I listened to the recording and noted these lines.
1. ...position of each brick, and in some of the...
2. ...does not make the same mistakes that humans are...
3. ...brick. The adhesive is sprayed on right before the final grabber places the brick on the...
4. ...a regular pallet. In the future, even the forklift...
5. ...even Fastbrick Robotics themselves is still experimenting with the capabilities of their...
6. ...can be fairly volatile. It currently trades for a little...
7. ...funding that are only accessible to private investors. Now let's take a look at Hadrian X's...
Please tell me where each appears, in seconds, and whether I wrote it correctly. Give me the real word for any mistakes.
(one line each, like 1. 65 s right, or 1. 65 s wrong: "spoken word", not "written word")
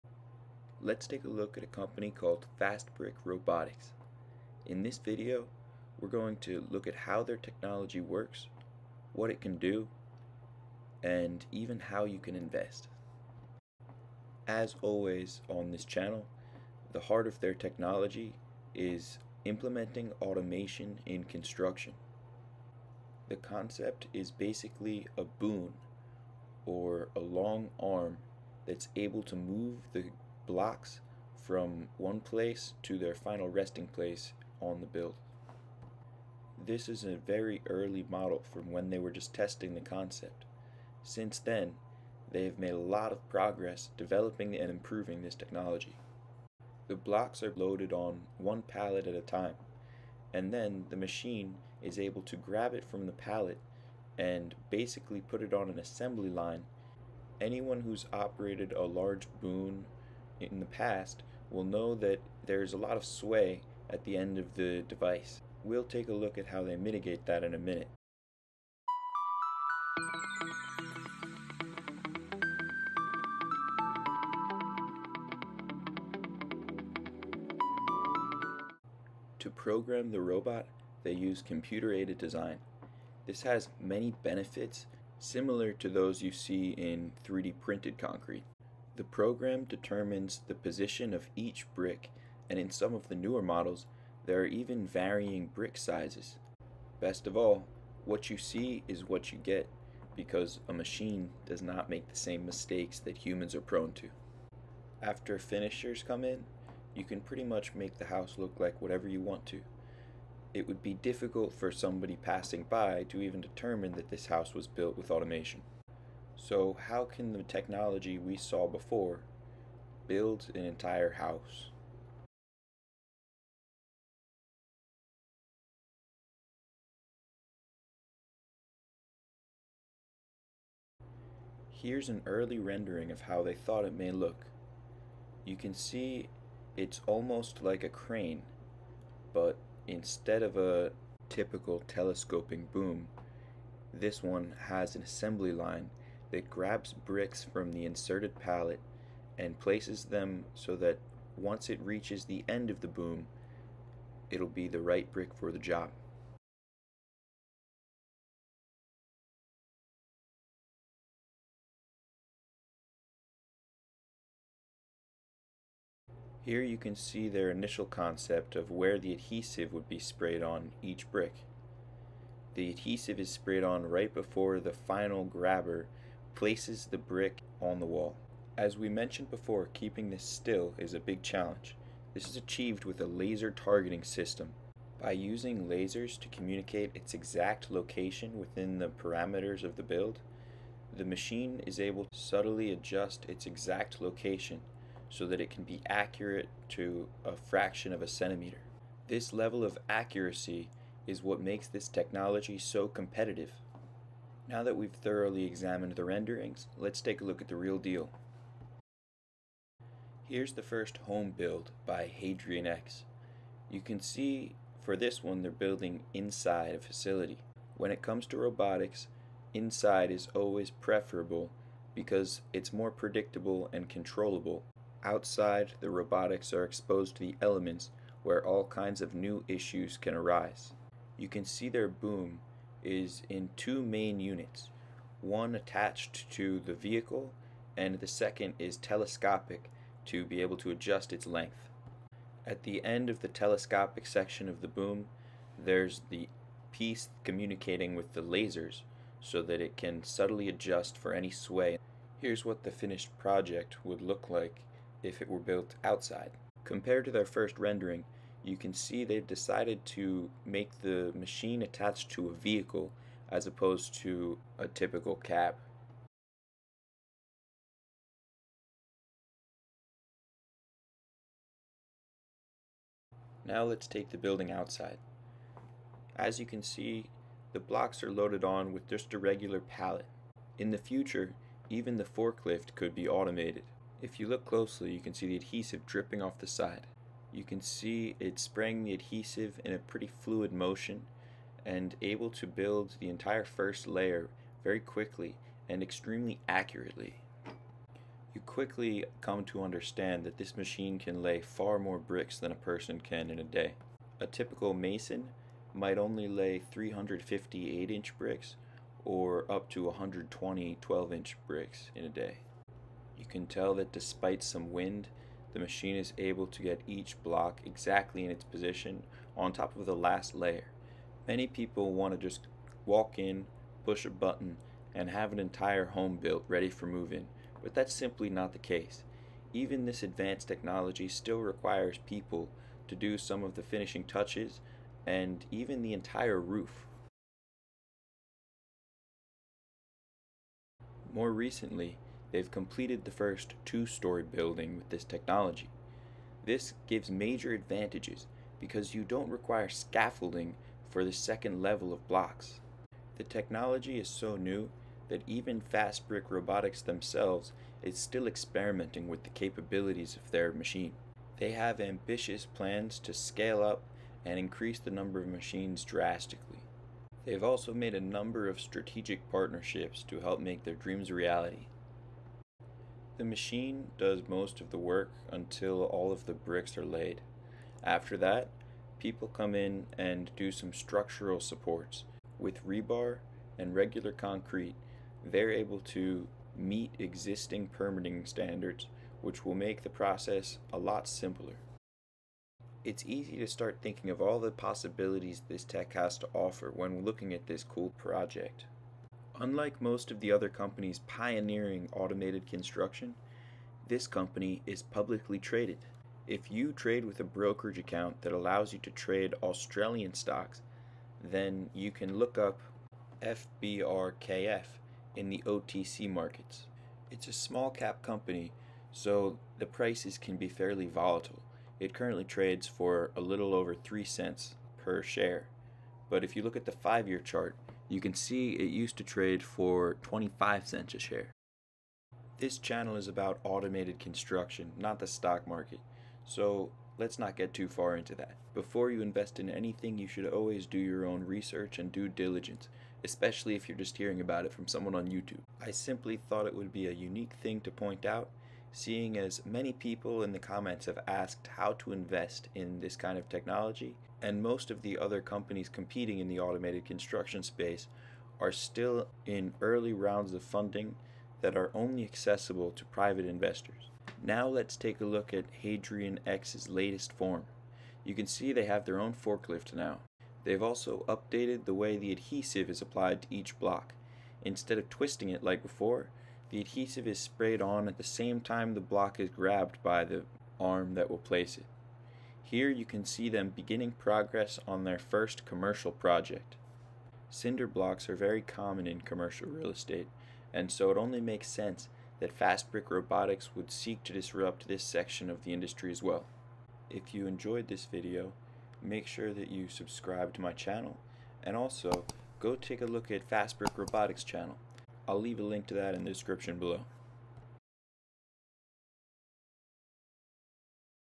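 1. 90 s right
2. 101 s right
3. 171 s right
4. 279 s right
5. 355 s right
6. 420 s right
7. 460 s right.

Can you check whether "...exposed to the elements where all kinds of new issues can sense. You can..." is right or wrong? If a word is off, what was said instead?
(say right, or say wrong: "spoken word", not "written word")
wrong: "arise", not "sense".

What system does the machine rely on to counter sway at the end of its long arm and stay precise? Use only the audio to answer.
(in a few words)
laser targeting system.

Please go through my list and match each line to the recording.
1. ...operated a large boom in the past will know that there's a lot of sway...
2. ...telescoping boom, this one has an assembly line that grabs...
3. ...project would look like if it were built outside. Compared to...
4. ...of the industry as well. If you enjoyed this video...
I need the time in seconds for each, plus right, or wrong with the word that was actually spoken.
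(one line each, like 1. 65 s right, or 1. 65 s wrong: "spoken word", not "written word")
1. 58 s right
2. 141 s right
3. 253 s right
4. 495 s right.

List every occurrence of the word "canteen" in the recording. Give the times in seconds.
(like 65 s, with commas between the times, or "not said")
not said.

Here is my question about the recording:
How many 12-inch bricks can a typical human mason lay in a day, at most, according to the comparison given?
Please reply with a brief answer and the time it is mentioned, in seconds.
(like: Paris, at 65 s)
120, at 309 s.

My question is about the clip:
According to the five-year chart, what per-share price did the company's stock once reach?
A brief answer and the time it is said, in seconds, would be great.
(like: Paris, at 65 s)
25 cents, at 430 s.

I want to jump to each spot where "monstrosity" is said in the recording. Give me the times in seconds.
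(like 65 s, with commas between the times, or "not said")
not said.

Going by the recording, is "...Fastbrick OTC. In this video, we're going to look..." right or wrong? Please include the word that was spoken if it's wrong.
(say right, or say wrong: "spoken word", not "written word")
wrong: "Robotics", not "OTC".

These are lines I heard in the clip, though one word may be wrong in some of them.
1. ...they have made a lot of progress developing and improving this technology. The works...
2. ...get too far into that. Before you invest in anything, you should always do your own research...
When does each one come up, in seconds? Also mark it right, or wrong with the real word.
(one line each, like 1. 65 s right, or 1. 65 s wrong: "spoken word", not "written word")
1. 42 s wrong: "blocks", not "works"
2. 437 s right.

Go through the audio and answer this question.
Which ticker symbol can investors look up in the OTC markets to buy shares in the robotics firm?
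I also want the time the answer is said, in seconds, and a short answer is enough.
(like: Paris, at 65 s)
FBRKF, at 413 s.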